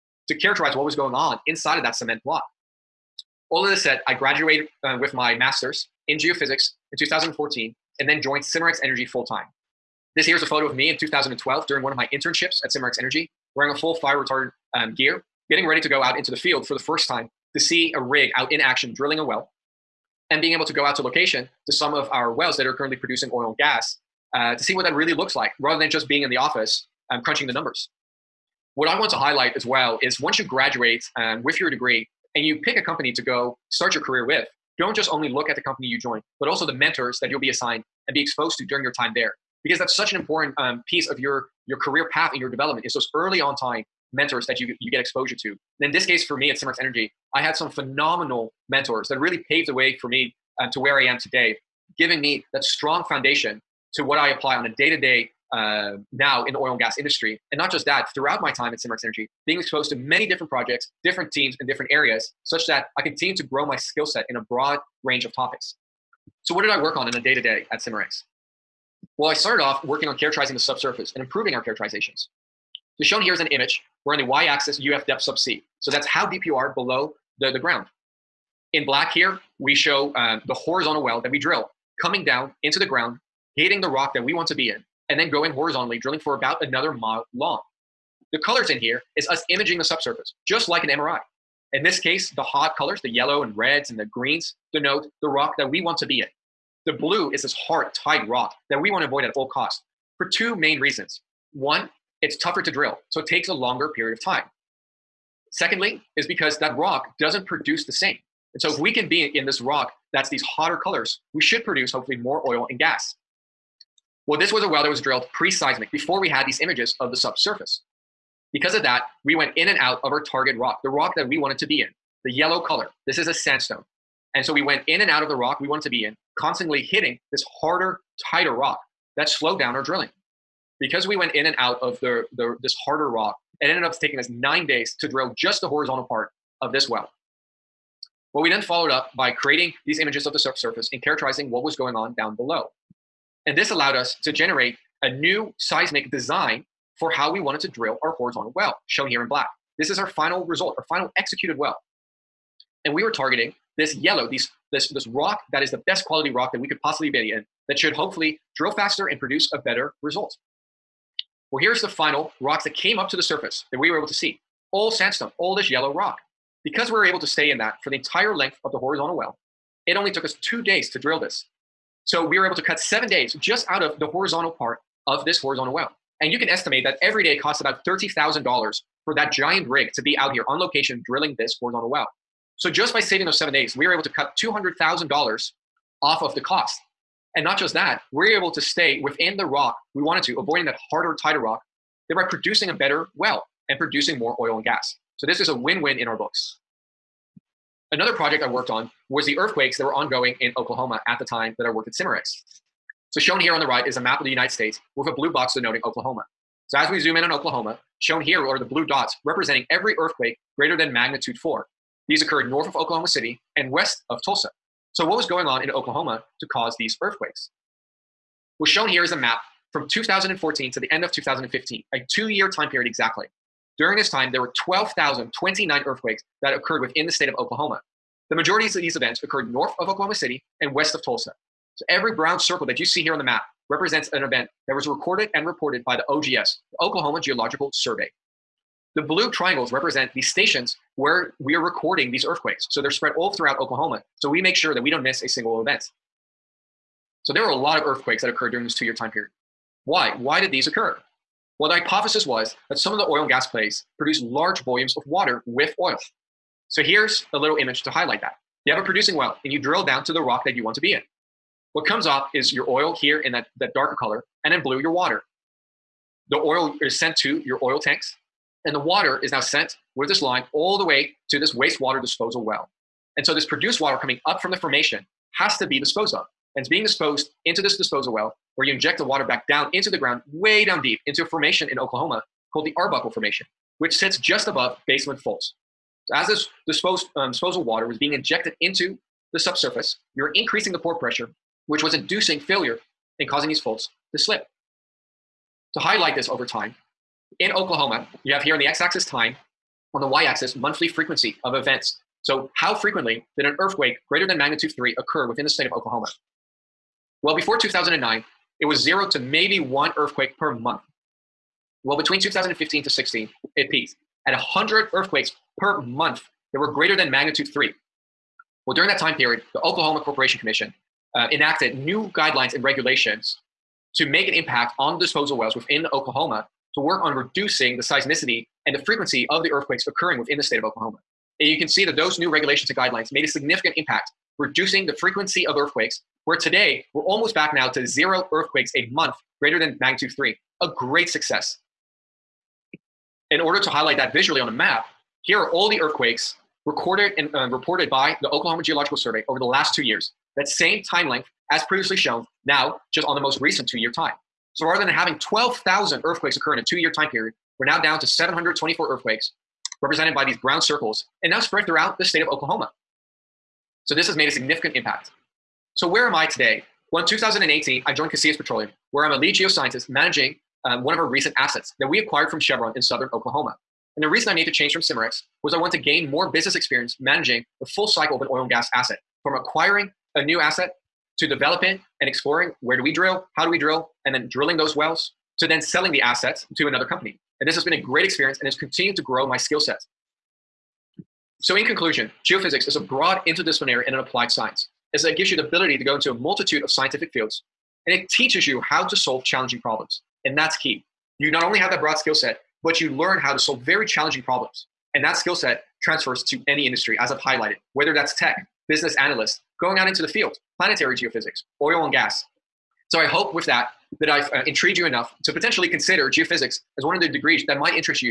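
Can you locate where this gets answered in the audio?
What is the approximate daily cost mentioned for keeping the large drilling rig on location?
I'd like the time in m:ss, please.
2:57.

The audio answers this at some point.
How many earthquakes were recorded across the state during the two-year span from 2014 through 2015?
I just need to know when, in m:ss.
3:44.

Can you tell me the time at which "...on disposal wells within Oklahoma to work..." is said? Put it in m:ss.
5:24.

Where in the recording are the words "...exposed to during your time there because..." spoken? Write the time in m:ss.
0:38.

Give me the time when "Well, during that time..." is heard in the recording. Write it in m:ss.
5:18.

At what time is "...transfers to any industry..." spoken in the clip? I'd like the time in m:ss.
6:45.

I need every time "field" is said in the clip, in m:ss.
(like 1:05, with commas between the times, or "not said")
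0:16, 6:37, 6:50.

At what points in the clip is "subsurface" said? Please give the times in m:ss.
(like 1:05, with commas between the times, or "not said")
1:10, 1:29, 1:57, 4:49.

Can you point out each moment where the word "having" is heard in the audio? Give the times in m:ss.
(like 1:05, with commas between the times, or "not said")
5:54.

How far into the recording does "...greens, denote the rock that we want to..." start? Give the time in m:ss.
1:34.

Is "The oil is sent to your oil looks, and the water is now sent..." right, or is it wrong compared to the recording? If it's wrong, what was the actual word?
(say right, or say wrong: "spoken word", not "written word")
wrong: "tanks", not "looks".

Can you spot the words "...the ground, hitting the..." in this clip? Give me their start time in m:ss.
1:22.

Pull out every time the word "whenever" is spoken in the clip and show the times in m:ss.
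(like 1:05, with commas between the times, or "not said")
not said.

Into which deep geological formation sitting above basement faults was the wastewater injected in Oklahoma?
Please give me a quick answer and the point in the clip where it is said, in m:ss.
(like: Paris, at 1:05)
Arbuckle Formation, at 4:42.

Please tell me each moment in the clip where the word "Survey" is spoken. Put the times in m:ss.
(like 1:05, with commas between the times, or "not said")
3:57, 5:48.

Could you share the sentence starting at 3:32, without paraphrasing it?
These occurred north of Oklahoma City and west of Tulsa.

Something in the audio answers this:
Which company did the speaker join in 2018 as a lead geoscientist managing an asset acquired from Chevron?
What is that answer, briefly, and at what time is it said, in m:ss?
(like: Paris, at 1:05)
Casillas Petroleum, at 6:08.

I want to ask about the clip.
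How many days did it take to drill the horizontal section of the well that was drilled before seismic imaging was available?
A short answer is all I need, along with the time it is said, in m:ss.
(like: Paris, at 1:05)
9, at 2:14.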